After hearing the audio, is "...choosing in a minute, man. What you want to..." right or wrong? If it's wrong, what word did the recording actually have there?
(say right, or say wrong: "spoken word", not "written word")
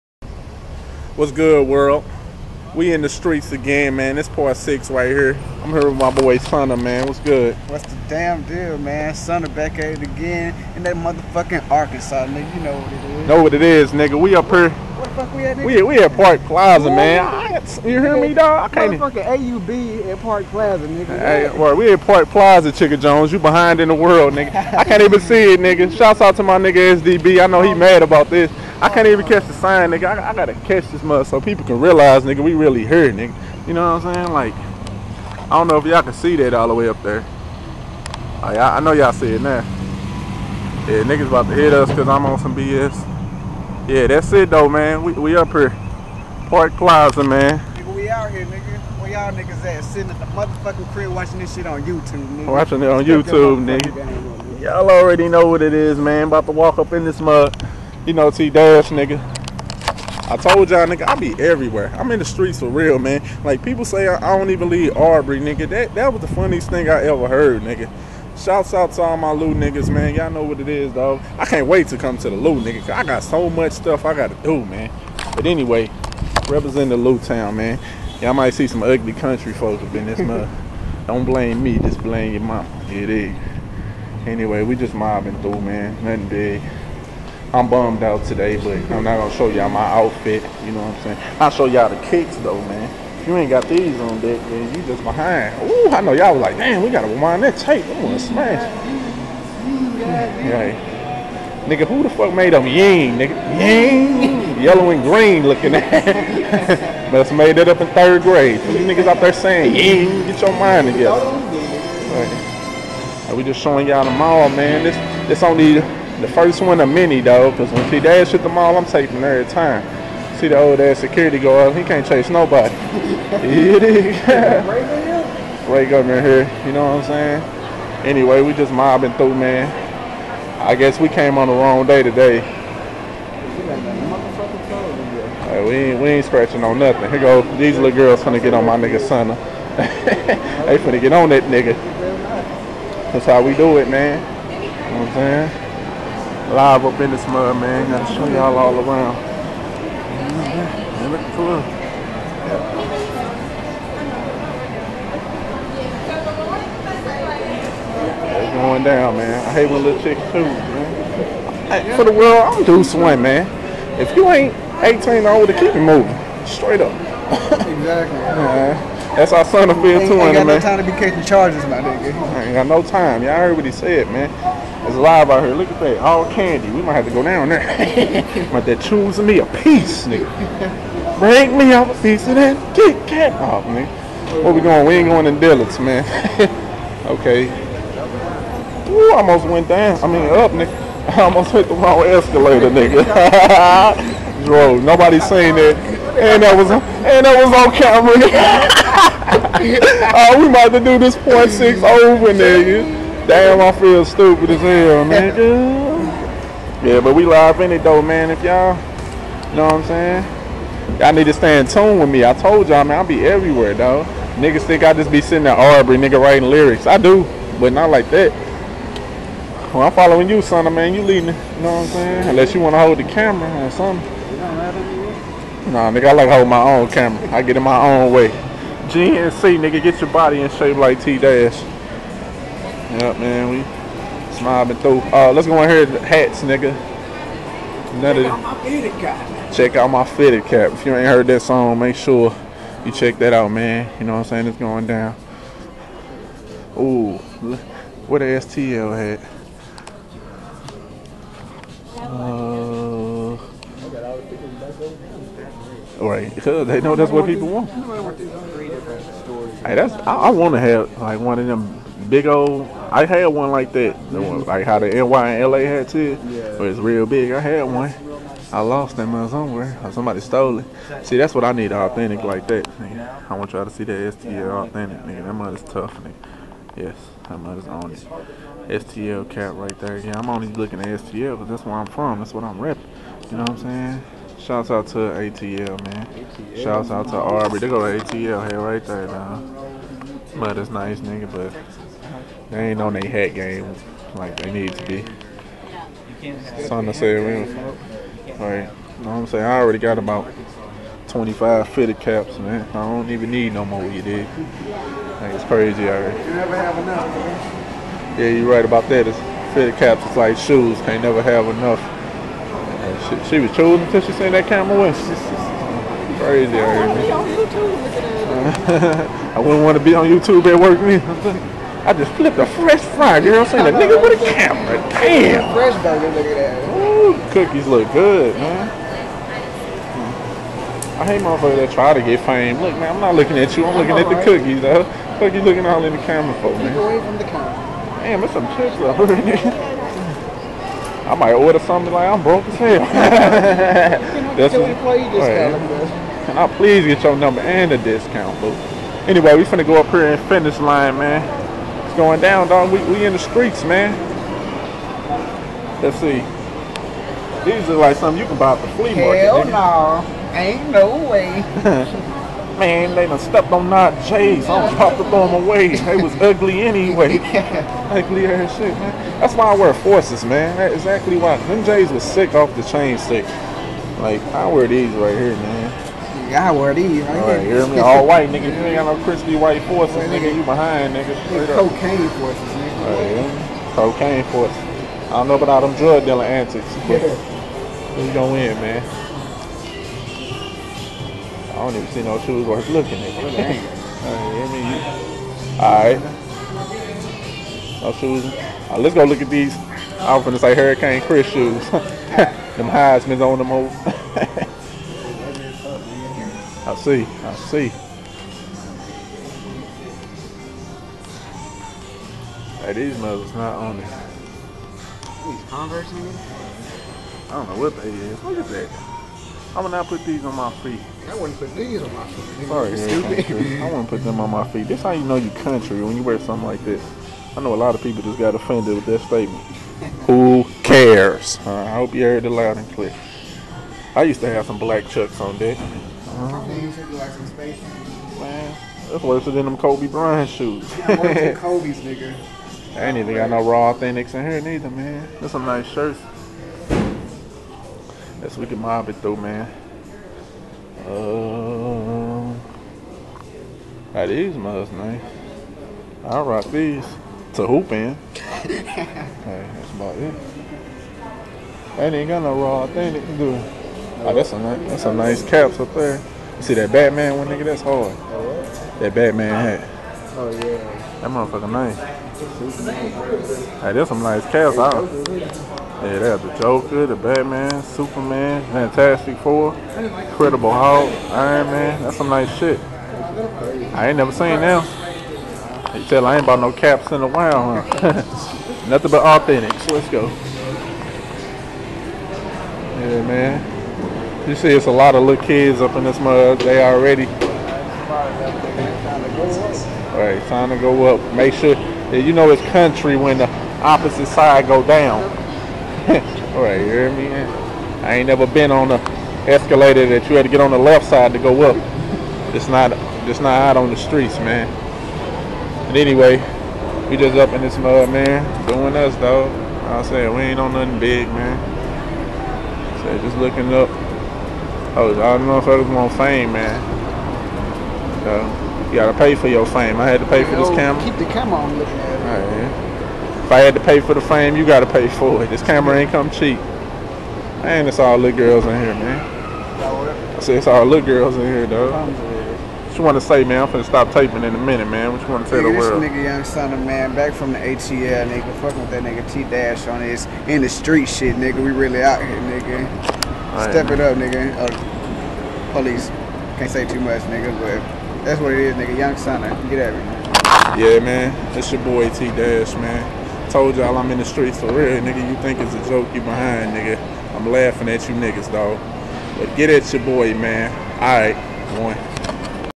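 wrong: "taping", not "choosing".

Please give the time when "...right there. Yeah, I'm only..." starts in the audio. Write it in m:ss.
4:39.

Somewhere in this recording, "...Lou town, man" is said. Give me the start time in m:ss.
1:16.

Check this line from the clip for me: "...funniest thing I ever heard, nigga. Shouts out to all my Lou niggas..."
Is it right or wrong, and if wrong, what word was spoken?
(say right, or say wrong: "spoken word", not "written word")
right.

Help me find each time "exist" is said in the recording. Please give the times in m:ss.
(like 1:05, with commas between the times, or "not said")
not said.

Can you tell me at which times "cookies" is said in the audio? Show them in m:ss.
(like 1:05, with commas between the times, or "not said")
5:27, 5:34.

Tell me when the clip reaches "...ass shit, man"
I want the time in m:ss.
6:08.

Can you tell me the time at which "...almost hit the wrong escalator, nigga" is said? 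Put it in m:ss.
3:11.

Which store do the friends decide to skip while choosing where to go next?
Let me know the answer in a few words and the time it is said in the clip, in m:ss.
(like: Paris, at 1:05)
Dillard's, at 3:05.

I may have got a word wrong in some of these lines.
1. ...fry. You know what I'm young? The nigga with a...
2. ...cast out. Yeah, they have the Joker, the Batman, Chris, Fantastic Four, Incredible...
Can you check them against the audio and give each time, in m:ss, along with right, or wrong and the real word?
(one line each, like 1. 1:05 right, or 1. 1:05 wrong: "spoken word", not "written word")
1. 5:22 wrong: "saying", not "young"
2. 7:54 wrong: "Superman", not "Chris".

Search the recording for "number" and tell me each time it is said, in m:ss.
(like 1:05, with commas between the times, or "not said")
5:47.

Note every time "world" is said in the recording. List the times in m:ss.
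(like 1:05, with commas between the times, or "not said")
0:01, 0:23, 2:42, 9:05.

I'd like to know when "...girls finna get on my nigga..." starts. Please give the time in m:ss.
2:17.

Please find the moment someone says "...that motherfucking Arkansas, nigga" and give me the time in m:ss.
0:10.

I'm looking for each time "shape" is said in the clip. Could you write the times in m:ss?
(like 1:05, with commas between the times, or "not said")
3:50.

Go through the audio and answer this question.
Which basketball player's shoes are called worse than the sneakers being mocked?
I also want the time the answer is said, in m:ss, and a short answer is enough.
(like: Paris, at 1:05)
Kobe Bryant, at 7:19.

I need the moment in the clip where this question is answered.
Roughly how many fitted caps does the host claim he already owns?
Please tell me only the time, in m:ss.
5:01.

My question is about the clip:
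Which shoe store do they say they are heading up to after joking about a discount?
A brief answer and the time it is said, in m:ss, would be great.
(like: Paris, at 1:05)
Finish Line, at 5:50.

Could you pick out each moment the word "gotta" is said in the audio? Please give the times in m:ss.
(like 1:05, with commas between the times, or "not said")
0:30, 1:36, 2:27, 8:48, 8:54.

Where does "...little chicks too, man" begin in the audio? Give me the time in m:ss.
2:39.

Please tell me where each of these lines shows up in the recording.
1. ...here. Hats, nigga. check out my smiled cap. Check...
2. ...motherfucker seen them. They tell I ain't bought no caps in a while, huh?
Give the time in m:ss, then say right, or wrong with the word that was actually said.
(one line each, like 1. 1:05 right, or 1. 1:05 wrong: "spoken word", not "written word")
1. 3:55 wrong: "fitted", not "smiled"
2. 8:03 wrong: "never", not "motherfucker".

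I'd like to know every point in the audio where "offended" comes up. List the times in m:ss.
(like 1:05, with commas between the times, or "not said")
7:08.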